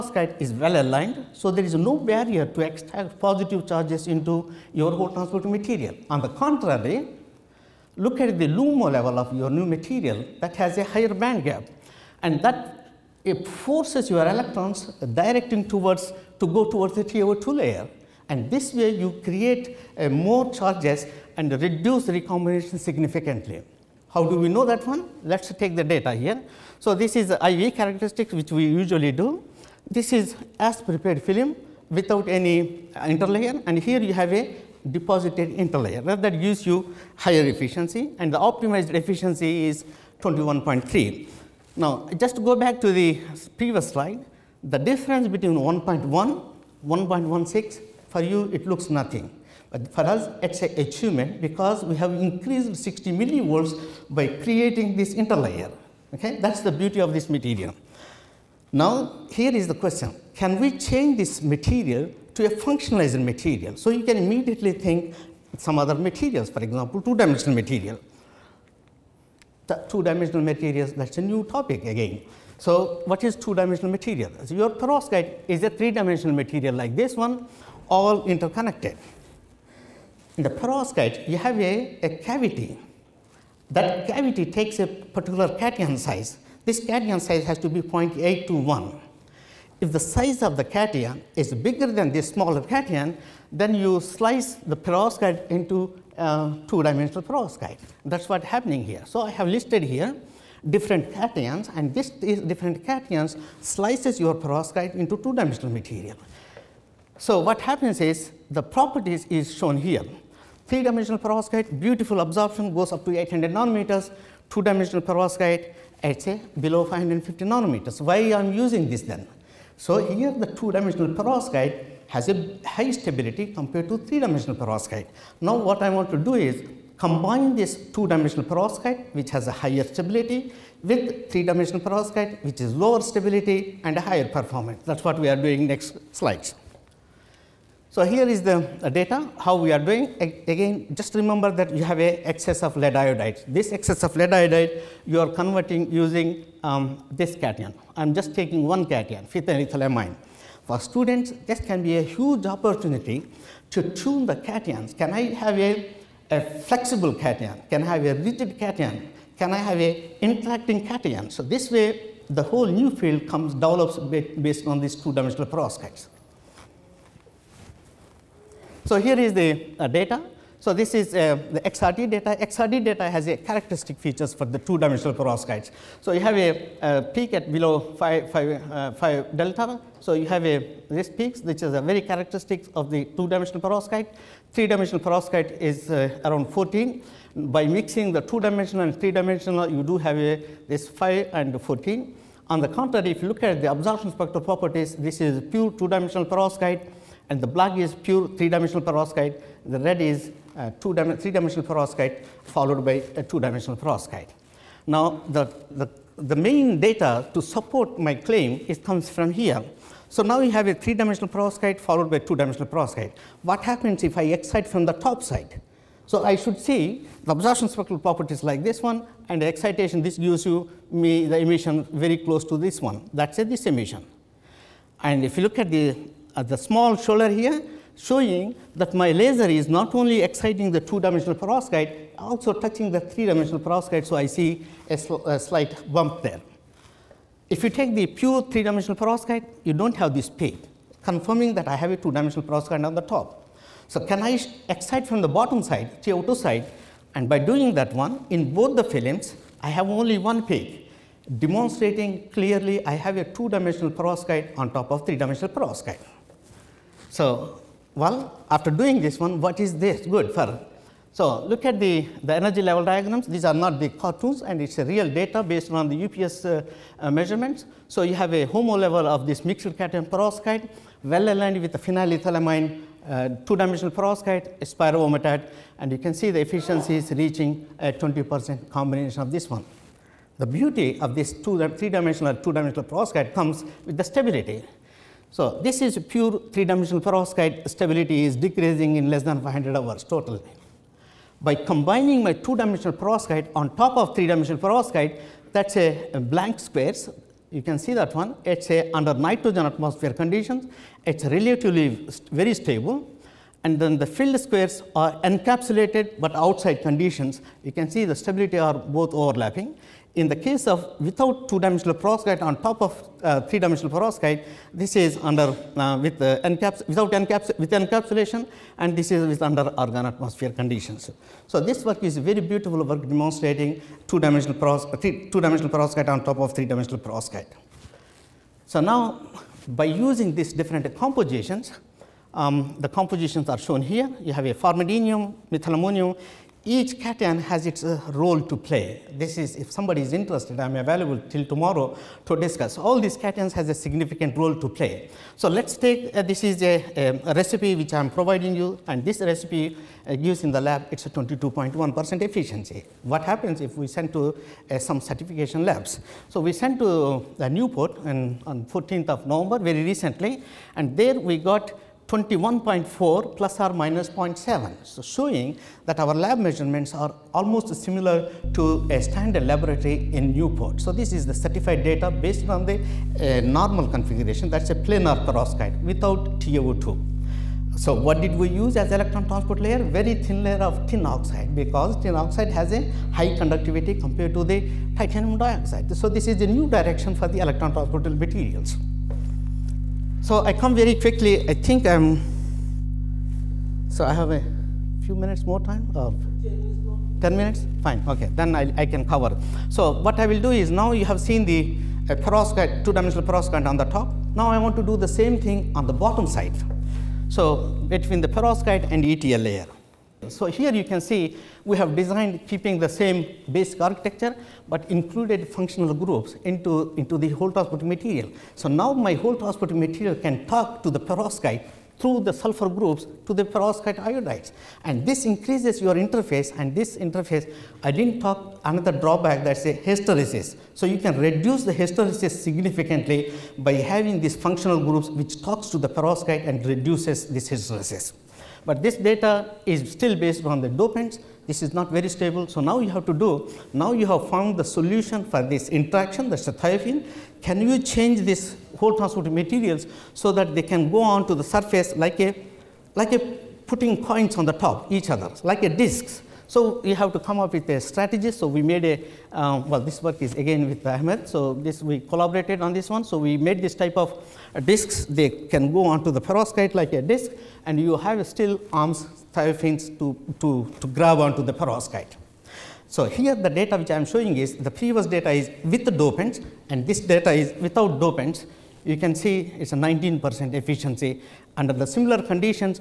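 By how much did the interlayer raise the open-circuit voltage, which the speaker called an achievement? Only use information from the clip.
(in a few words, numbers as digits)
60 millivolts.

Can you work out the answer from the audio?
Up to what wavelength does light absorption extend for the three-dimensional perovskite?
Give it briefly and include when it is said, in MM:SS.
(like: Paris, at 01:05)
800 nanometers, at 01:53.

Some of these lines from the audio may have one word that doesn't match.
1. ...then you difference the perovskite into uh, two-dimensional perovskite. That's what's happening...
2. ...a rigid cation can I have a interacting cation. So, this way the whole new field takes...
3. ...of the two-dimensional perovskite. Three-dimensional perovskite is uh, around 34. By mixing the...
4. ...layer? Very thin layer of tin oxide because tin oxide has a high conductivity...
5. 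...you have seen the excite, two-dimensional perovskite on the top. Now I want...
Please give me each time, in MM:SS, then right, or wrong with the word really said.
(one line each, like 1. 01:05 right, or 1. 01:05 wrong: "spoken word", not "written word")
1. 01:33 wrong: "slice", not "difference"
2. 02:38 wrong: "comes", not "takes"
3. 03:02 wrong: "14", not "34"
4. 06:19 right
5. 06:40 wrong: "perovskite", not "excite".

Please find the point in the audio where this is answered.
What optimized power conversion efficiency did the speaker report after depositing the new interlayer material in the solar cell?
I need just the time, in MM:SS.
00:40.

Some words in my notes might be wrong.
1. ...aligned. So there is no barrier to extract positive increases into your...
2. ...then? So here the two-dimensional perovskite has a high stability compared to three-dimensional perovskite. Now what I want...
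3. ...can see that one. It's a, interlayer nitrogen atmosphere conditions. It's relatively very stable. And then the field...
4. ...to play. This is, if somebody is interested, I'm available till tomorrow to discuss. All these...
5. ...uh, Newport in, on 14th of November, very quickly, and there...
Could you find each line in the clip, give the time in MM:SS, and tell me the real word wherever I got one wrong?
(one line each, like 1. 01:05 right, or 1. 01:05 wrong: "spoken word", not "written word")
1. 00:00 wrong: "charges", not "increases"
2. 01:59 right
3. 04:57 wrong: "under", not "interlayer"
4. 05:38 right
5. 05:57 wrong: "recently", not "quickly".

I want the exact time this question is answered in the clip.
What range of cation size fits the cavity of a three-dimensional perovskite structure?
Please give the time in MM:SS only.
01:27.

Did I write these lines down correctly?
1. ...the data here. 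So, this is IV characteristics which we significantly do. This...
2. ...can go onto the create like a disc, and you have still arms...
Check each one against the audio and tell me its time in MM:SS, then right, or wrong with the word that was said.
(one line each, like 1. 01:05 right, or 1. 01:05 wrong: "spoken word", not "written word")
1. 00:25 wrong: "usually", not "significantly"
2. 07:45 wrong: "perovskite", not "create".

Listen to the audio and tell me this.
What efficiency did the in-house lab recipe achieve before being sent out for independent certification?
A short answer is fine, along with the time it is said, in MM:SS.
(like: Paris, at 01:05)
22.1%, at 05:51.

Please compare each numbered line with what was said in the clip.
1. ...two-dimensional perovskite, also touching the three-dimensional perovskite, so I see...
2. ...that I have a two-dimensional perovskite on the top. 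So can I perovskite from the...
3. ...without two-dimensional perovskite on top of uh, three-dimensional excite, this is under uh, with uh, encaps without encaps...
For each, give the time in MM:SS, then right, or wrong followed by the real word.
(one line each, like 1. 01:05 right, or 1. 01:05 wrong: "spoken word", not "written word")
1. 03:50 right
2. 04:01 wrong: "excite", not "perovskite"
3. 05:10 wrong: "perovskite", not "excite".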